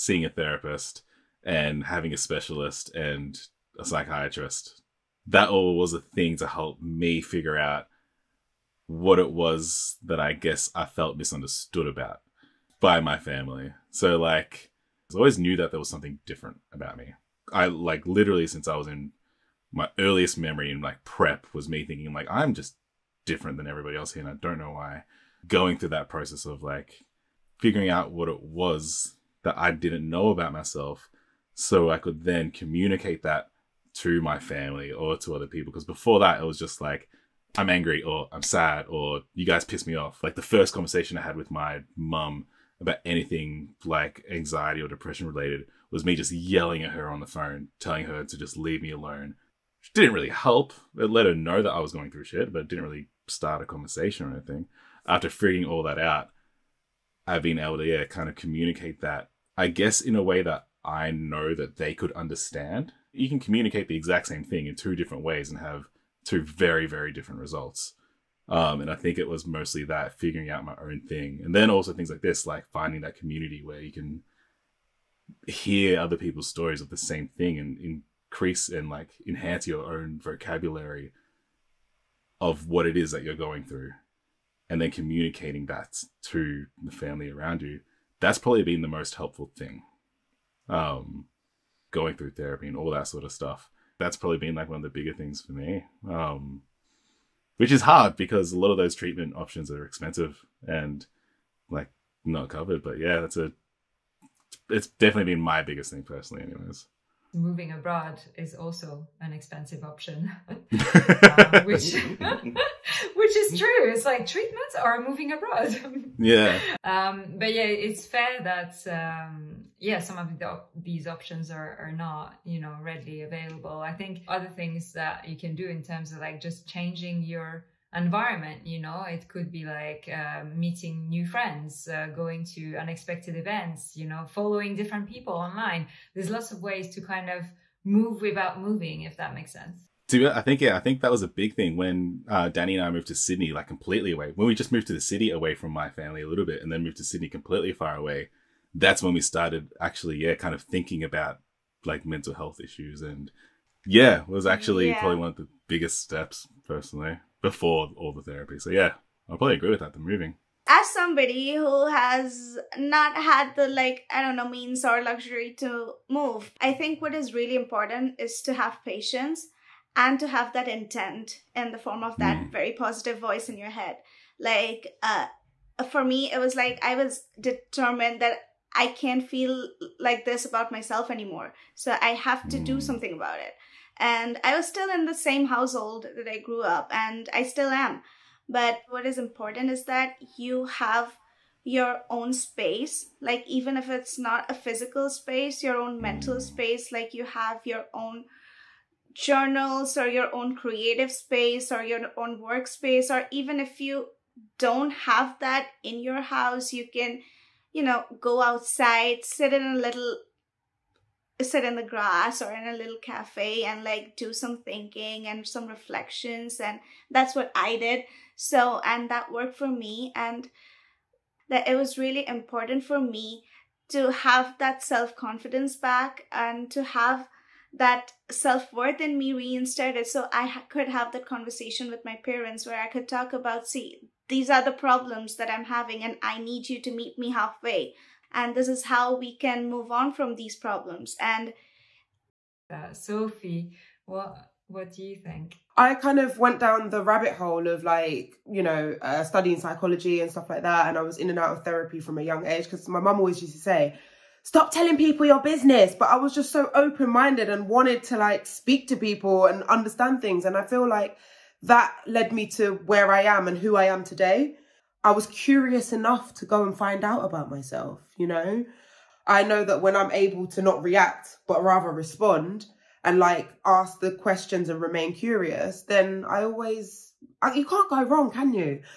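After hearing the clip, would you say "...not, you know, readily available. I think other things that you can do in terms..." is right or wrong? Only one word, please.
right.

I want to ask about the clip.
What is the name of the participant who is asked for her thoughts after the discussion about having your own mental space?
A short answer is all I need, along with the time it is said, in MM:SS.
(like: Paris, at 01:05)
Sophie, at 04:02.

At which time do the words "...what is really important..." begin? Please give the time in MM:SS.
02:47.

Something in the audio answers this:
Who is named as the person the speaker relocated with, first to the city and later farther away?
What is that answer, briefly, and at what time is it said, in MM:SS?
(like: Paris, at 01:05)
Danny, at 02:22.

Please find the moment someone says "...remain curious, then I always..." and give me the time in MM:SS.
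04:34.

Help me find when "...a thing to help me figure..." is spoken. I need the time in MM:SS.
00:05.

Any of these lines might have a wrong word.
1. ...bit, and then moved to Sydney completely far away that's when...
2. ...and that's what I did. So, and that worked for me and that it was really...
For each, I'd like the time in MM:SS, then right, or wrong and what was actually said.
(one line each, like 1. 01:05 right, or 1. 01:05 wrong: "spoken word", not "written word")
1. 02:26 right
2. 03:36 right.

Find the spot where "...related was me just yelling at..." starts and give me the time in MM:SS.
00:45.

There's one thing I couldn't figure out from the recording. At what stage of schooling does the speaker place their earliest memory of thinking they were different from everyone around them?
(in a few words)
Prep.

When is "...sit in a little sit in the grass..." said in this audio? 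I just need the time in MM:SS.
03:29.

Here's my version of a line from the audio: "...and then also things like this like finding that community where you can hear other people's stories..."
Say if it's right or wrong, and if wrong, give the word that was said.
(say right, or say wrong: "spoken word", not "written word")
right.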